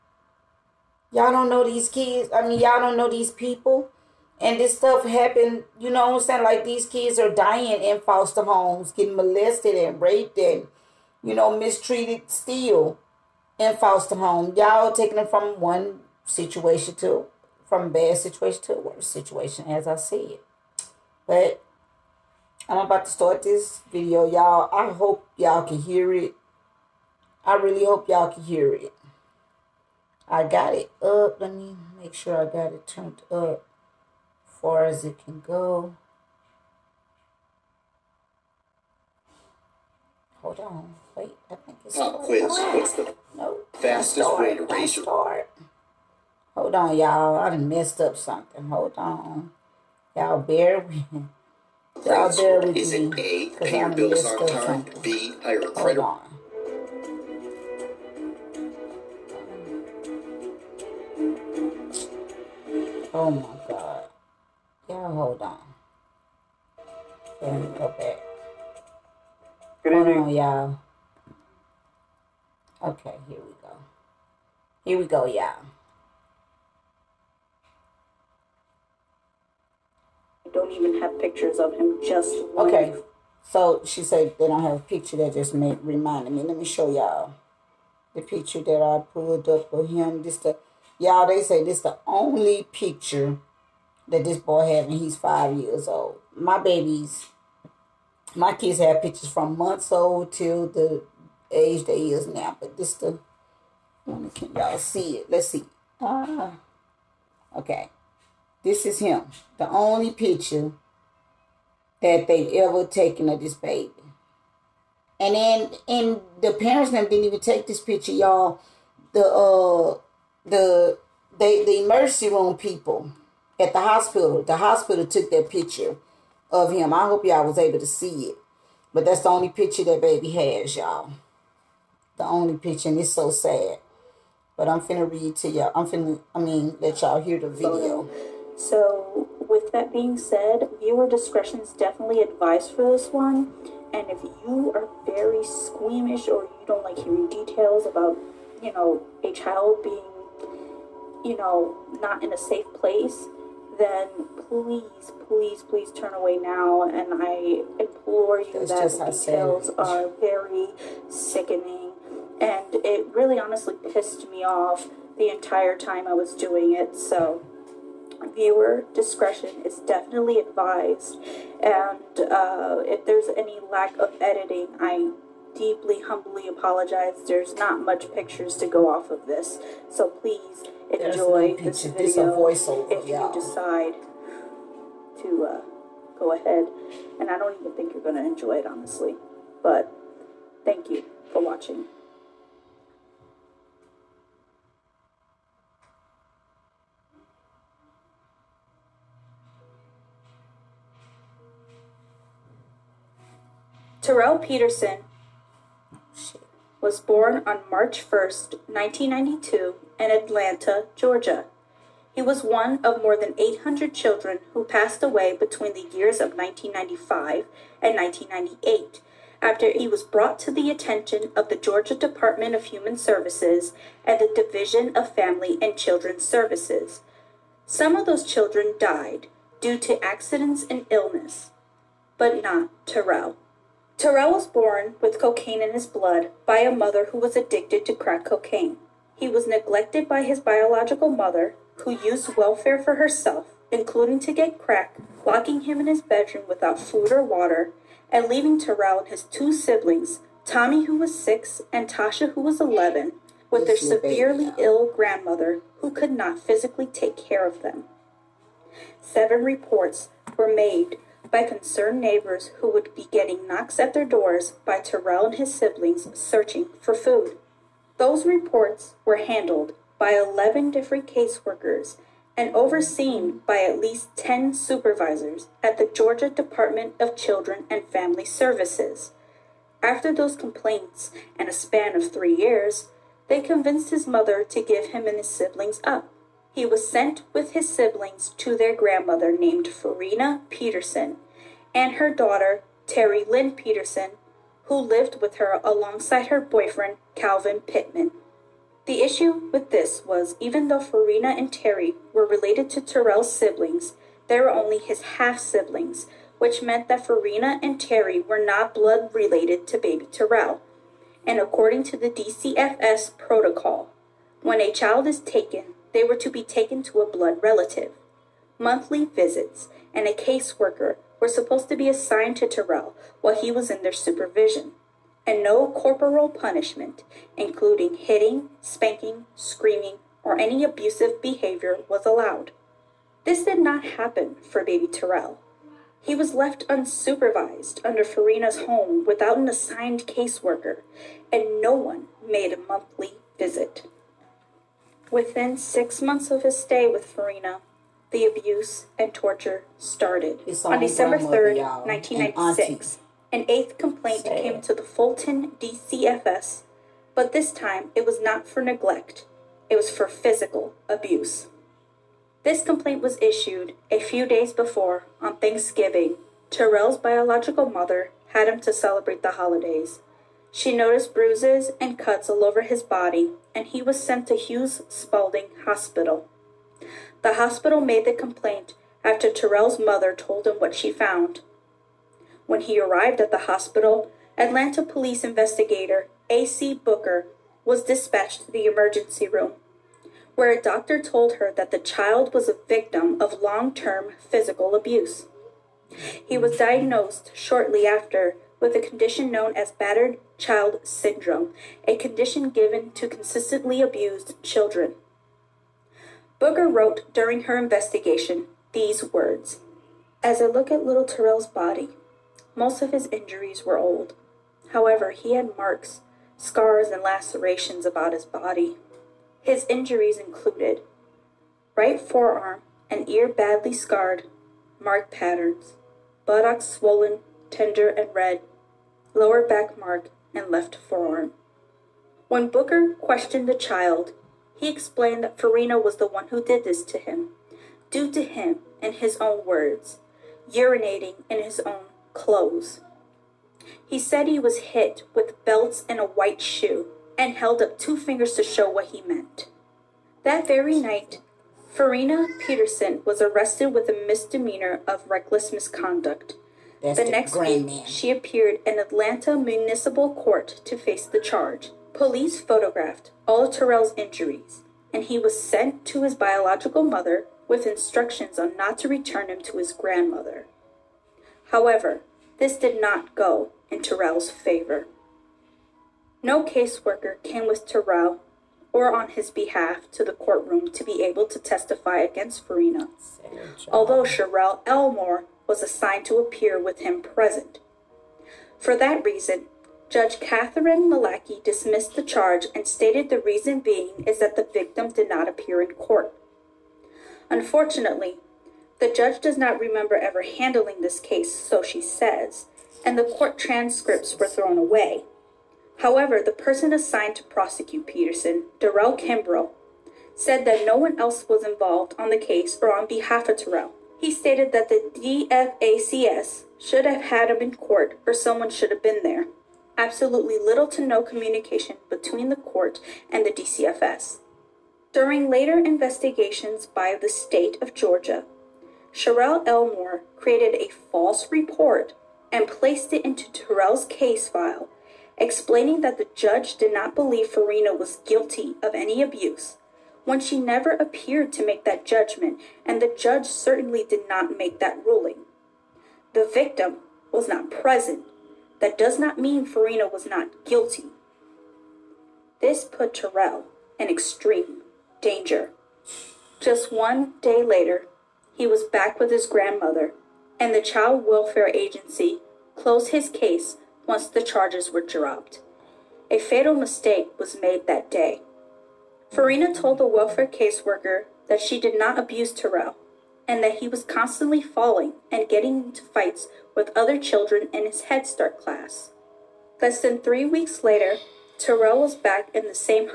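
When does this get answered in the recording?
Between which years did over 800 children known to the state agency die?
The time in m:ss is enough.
3:36.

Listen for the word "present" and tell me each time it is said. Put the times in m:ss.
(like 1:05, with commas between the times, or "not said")
8:07, 9:07.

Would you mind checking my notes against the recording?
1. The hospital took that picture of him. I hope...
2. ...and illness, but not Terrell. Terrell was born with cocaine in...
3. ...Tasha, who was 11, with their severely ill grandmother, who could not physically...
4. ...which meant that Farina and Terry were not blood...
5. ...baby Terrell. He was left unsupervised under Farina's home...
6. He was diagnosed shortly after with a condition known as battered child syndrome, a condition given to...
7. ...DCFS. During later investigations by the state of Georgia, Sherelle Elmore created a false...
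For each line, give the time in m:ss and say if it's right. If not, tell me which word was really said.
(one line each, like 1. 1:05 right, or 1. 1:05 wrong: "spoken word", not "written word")
1. 2:04 right
2. 3:50 right
3. 4:11 right
4. 5:06 right
5. 5:34 right
6. 6:36 right
7. 8:43 right.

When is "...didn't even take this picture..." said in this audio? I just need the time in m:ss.
1:57.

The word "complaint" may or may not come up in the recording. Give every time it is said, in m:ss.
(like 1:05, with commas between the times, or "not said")
4:40, 5:53, 6:02, 6:18.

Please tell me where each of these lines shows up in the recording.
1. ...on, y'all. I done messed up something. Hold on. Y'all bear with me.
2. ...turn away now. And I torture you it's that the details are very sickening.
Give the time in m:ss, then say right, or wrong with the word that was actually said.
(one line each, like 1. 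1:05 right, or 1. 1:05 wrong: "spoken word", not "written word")
1. 0:46 right
2. 2:35 wrong: "implore", not "torture".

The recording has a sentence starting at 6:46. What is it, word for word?
Booker wrote during her investigation these words As I look at little Terrell's body, most of his injuries were old.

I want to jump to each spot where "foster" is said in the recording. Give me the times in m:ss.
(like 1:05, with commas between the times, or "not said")
0:08, 0:13.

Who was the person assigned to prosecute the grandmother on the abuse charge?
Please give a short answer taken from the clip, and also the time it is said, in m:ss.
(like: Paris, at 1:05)
Darrell Kimbrell, at 8:28.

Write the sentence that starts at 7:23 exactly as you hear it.
He said he was hit with belts and a white shoe and held up two fingers to show what he meant.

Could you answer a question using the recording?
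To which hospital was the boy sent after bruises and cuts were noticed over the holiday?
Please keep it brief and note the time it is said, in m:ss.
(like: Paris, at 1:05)
Hughes Spalding Hospital, at 6:14.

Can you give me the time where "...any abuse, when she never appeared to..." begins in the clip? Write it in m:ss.
8:58.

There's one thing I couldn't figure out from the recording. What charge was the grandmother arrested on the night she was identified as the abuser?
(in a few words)
reckless misconduct.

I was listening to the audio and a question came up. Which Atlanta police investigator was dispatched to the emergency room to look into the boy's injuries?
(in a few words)
A.C. Booker.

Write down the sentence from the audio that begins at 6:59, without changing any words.
His injuries included right forearm and ear badly scarred, mark patterns, buttocks swollen, tender, and red, lower back mark, and left forearm.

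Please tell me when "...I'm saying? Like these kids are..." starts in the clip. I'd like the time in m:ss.
0:06.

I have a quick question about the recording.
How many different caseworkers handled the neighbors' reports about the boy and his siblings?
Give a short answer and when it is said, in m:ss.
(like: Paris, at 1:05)
11, at 4:30.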